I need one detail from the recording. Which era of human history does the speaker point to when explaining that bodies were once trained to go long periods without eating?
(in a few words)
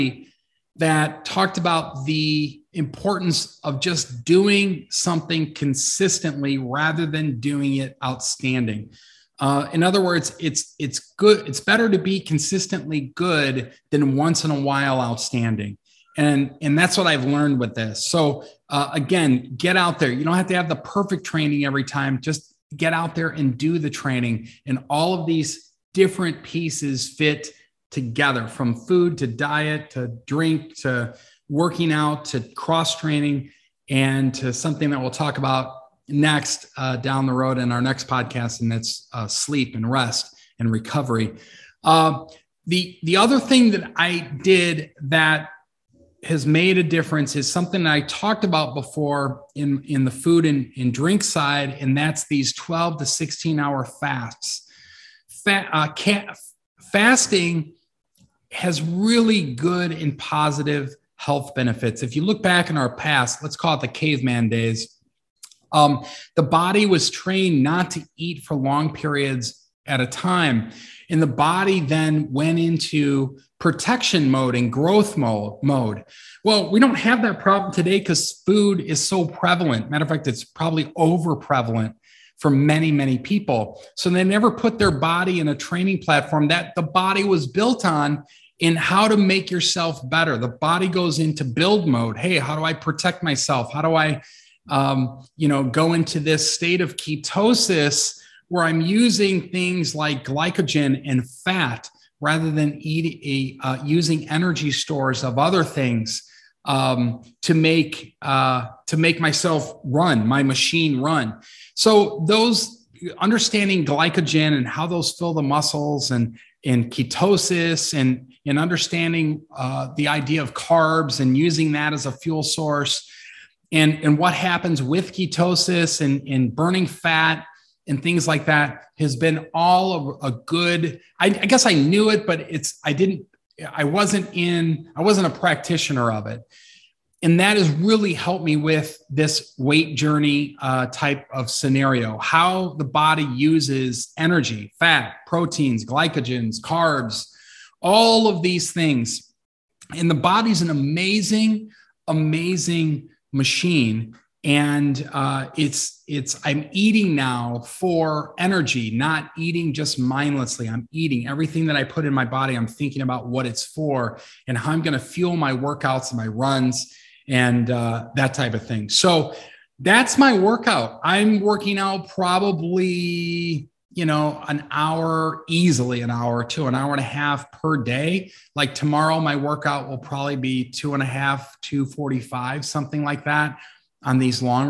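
Caveman days.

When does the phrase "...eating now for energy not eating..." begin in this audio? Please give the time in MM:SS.
02:36.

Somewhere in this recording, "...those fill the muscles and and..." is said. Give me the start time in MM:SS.
01:54.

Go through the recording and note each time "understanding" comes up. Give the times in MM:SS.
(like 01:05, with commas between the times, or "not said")
01:53, 01:58.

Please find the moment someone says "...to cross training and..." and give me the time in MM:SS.
00:32.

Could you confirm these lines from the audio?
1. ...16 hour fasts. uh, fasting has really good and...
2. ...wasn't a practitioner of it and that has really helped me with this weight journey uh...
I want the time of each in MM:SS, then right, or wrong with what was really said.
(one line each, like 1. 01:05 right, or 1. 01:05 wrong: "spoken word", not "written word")
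1. 00:53 right
2. 02:15 right.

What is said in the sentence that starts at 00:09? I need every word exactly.
Uh, in other words, it's it's good.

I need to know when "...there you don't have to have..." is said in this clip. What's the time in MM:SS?
00:19.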